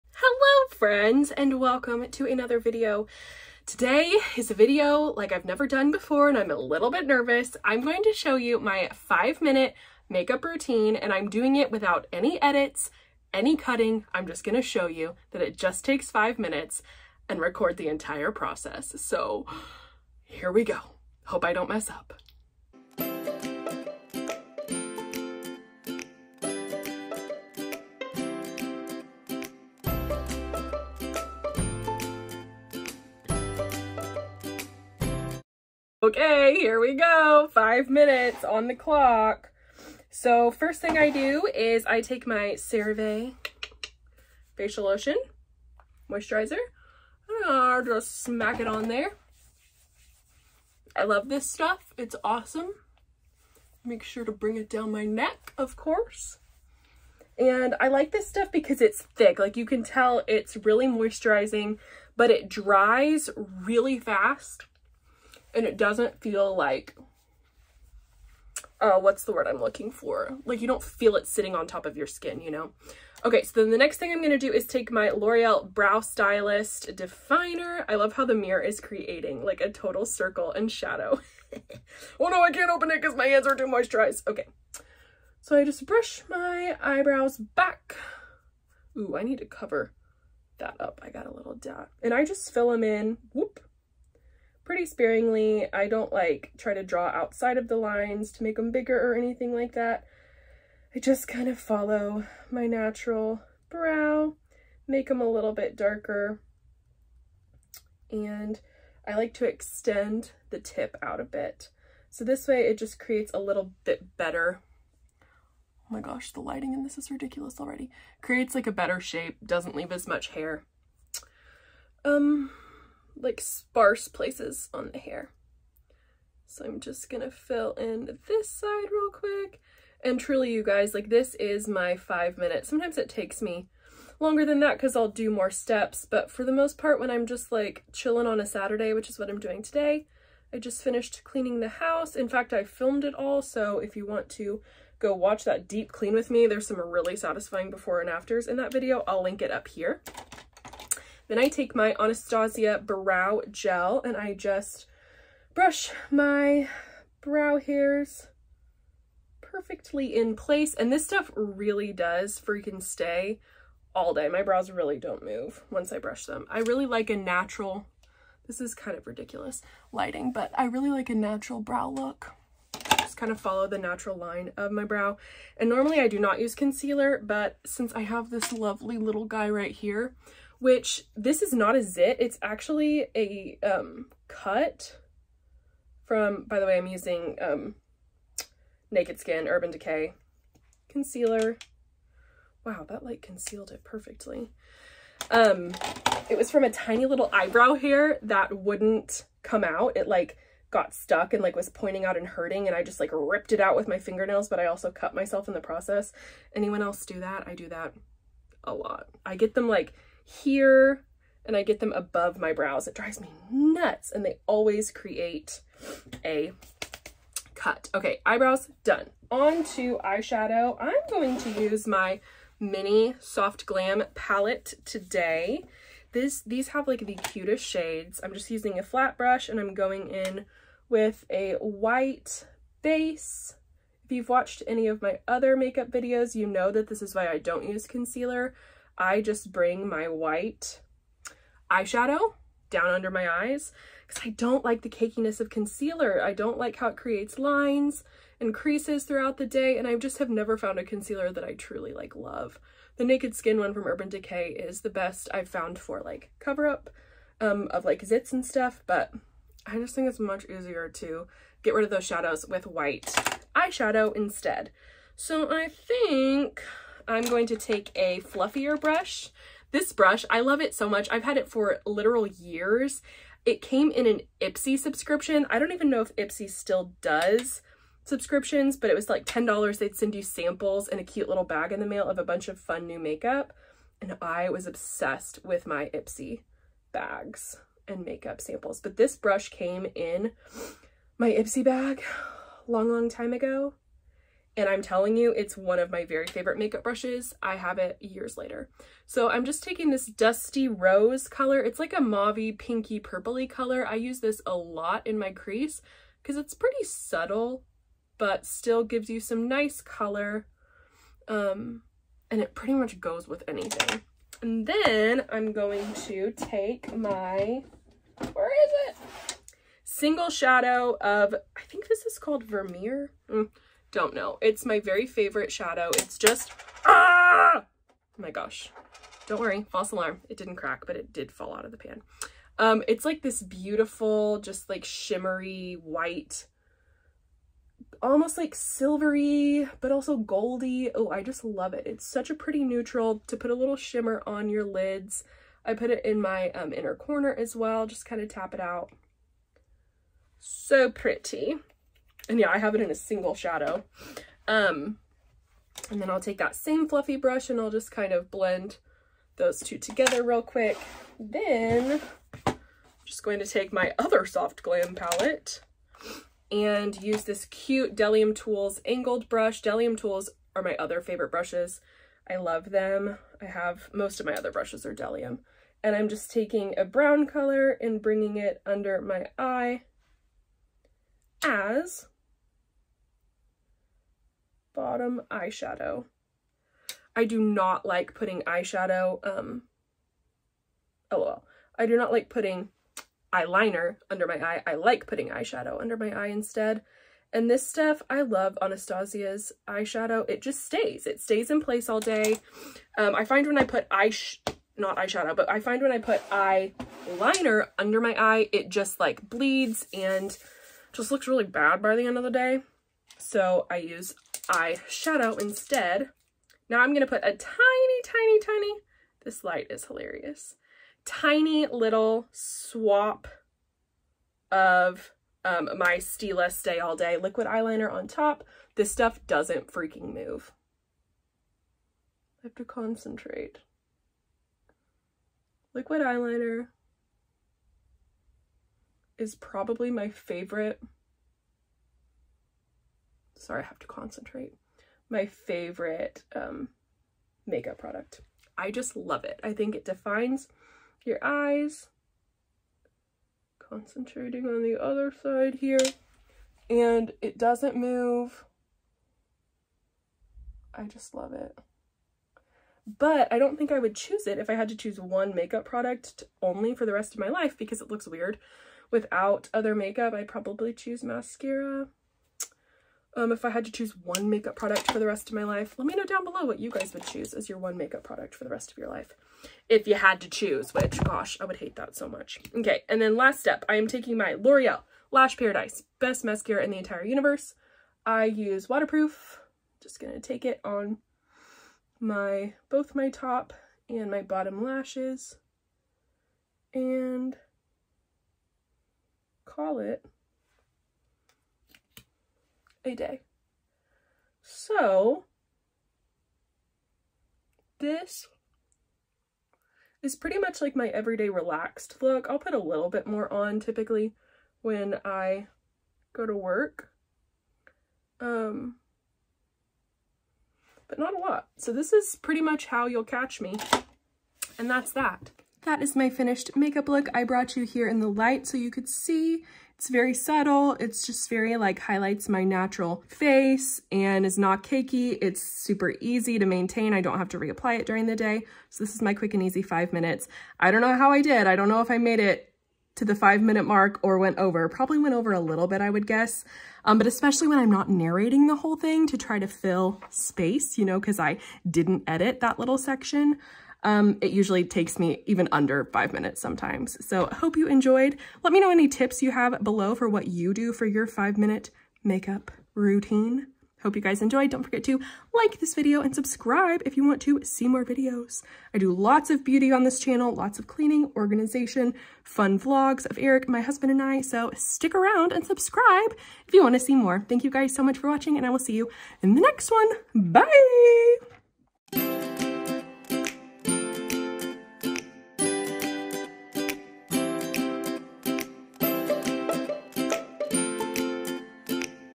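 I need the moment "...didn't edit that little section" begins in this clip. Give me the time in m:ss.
9:11.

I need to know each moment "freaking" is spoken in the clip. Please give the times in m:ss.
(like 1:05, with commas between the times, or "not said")
2:42, 7:09.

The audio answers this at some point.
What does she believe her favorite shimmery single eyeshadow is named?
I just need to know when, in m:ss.
5:22.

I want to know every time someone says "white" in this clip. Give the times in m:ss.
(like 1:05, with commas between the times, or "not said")
3:51, 4:00, 4:22, 5:35.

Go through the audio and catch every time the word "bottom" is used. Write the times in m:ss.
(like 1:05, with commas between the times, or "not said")
6:24, 8:14.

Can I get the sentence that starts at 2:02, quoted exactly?
Um, like sparse places on the hair.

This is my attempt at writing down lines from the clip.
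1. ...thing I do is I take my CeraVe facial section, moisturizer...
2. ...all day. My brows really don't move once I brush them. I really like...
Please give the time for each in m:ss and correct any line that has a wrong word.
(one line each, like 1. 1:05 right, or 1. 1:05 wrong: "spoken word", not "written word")
1. 0:40 wrong: "lotion", not "section"
2. 2:43 right.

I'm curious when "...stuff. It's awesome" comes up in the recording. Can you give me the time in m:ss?
0:51.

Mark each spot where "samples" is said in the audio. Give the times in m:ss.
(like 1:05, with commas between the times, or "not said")
4:40, 4:48.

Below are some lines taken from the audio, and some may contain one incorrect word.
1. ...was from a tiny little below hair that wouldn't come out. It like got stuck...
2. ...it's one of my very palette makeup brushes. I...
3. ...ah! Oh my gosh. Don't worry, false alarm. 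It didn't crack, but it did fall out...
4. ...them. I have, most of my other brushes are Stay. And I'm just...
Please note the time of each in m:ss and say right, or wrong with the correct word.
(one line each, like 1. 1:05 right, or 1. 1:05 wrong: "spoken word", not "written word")
1. 3:16 wrong: "eyebrow", not "below"
2. 4:55 wrong: "favorite", not "palette"
3. 5:26 right
4. 6:12 wrong: "Bdellium", not "Stay".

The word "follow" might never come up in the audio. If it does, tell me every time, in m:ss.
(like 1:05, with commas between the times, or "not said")
1:41, 2:53.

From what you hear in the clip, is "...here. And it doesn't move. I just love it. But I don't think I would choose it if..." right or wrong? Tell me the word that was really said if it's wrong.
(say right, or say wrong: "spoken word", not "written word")
right.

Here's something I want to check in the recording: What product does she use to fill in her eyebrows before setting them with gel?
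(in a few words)
L'Oreal Brow Stylist Definer.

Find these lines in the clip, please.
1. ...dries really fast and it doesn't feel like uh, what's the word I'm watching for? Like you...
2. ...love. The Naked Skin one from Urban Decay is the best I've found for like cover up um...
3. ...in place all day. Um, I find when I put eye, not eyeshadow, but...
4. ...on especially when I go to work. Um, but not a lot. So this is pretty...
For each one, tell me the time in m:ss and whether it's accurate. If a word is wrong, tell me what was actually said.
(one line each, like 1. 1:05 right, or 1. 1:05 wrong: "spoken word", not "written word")
1. 1:02 wrong: "looking", not "watching"
2. 4:12 right
3. 6:41 right
4. 8:33 wrong: "typically", not "especially".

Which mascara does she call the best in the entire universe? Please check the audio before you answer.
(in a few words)
L'Oreal Lash Paradise.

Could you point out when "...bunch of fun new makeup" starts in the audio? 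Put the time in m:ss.
4:42.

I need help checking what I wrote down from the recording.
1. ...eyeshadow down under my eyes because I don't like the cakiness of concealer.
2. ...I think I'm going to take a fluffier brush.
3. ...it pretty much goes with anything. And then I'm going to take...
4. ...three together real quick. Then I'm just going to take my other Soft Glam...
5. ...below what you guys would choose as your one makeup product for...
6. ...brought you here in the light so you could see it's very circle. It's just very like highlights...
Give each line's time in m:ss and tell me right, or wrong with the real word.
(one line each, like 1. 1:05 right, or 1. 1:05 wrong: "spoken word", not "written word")
1. 4:01 right
2. 4:25 right
3. 5:12 right
4. 5:59 wrong: "two", not "three"
5. 7:56 right
6. 8:47 wrong: "subtle", not "circle".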